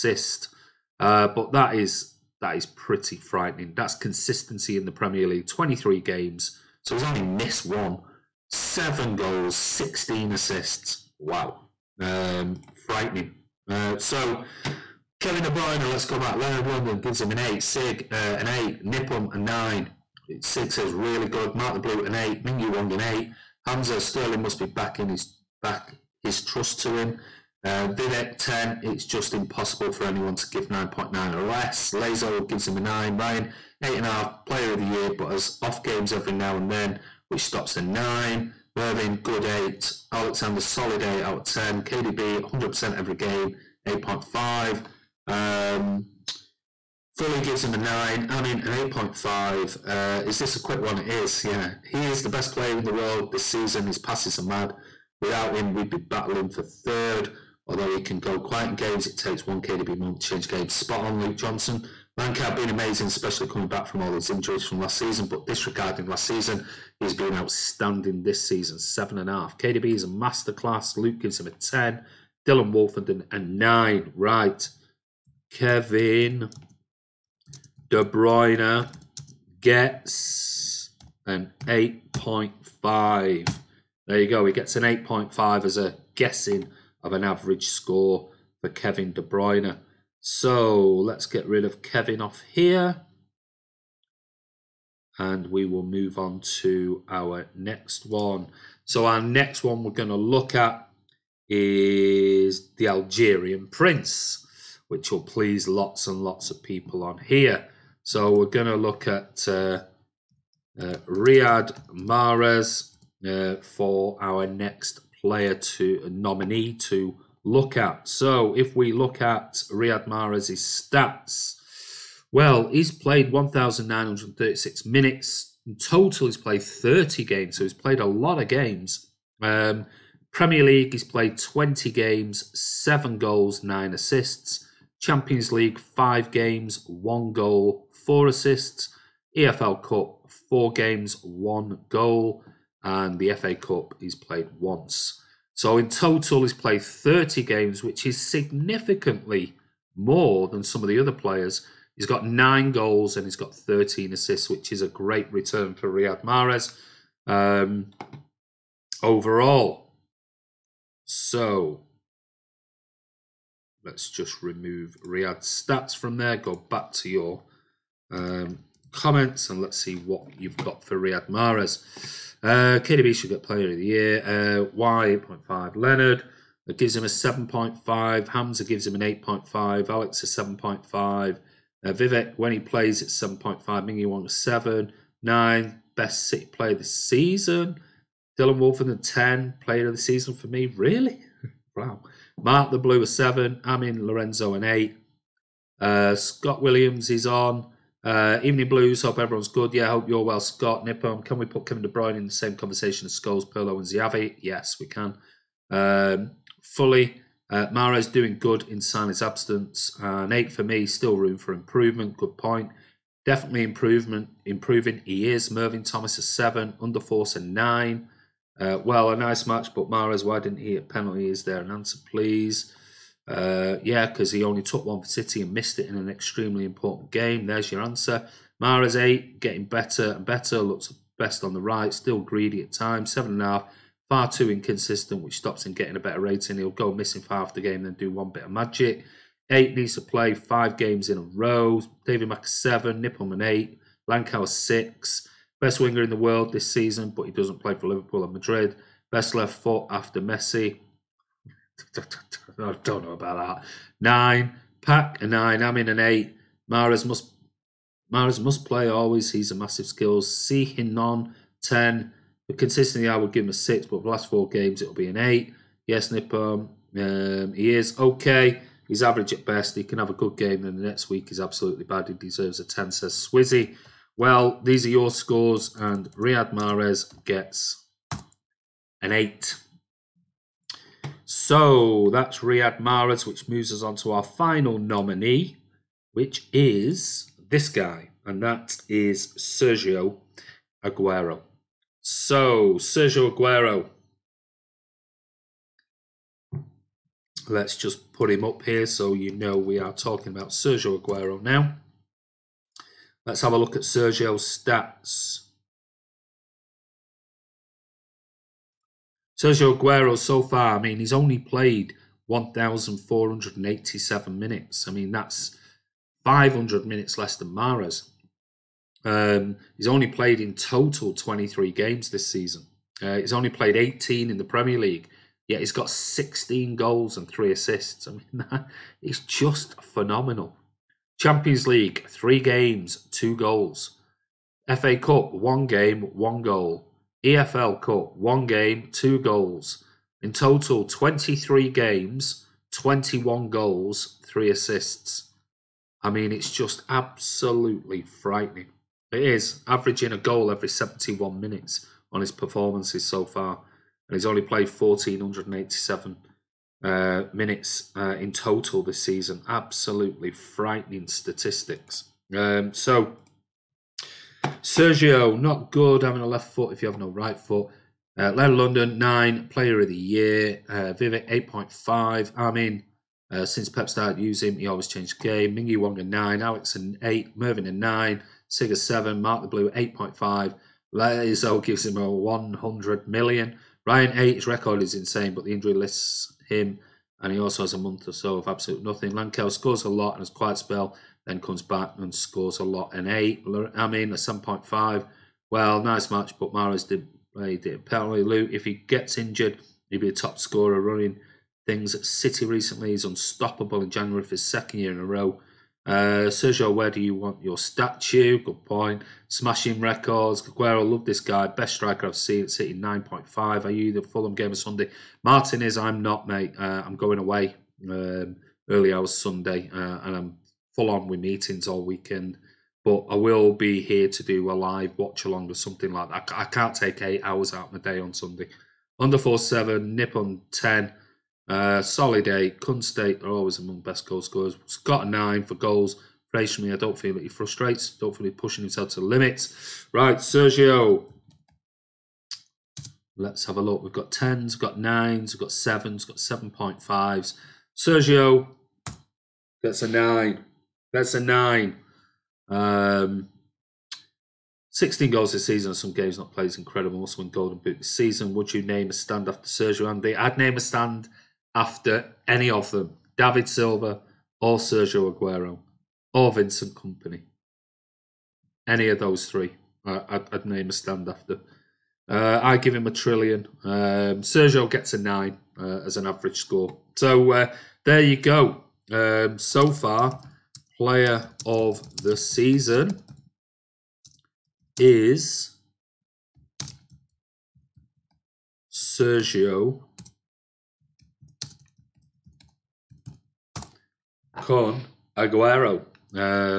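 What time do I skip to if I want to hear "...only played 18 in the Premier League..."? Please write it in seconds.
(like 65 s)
323 s.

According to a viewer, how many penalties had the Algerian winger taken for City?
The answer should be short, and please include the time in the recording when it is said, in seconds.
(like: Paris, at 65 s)
1, at 224 s.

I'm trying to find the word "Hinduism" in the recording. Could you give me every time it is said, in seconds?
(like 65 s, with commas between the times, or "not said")
not said.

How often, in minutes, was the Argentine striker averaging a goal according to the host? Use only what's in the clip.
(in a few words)
71.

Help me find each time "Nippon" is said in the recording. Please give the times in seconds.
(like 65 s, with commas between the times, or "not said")
18 s, 200 s, 243 s, 266 s.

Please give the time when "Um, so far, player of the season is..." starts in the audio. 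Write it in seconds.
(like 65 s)
478 s.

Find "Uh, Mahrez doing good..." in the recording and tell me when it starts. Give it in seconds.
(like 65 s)
207 s.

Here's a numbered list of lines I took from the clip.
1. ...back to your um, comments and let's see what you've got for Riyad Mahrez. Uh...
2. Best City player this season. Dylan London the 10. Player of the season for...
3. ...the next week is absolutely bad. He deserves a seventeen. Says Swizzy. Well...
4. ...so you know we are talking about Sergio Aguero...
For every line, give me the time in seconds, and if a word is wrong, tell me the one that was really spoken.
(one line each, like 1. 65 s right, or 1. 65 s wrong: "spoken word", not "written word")
1. 166 s right
2. 185 s wrong: "Wolfen", not "London"
3. 270 s wrong: "ten", not "seventeen"
4. 298 s right.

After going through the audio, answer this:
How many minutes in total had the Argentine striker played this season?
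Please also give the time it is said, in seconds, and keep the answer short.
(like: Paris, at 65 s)
1,487, at 312 s.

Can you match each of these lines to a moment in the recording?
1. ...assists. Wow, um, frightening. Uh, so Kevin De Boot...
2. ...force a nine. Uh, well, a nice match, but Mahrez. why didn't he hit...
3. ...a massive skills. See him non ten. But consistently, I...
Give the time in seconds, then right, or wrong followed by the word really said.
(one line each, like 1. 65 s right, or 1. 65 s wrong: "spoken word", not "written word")
1. 10 s wrong: "Bruyne", not "Boot"
2. 216 s right
3. 259 s right.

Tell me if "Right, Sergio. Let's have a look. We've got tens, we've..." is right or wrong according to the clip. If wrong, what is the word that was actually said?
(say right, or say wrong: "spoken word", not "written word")
right.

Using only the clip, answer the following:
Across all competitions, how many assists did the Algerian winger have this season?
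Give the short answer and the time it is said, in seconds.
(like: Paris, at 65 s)
13, at 153 s.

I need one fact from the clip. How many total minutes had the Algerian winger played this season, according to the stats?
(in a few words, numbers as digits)
1,936.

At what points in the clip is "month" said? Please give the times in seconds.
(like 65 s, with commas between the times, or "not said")
59 s, 387 s.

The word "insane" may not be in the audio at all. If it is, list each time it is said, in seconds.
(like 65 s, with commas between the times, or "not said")
384 s.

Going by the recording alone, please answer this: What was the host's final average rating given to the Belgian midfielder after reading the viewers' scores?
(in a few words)
8.5.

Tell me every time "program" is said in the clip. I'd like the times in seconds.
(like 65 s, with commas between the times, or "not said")
not said.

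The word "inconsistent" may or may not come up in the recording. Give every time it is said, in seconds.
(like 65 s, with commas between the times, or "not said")
234 s.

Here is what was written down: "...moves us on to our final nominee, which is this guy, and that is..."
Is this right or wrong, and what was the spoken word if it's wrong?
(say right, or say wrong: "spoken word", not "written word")
right.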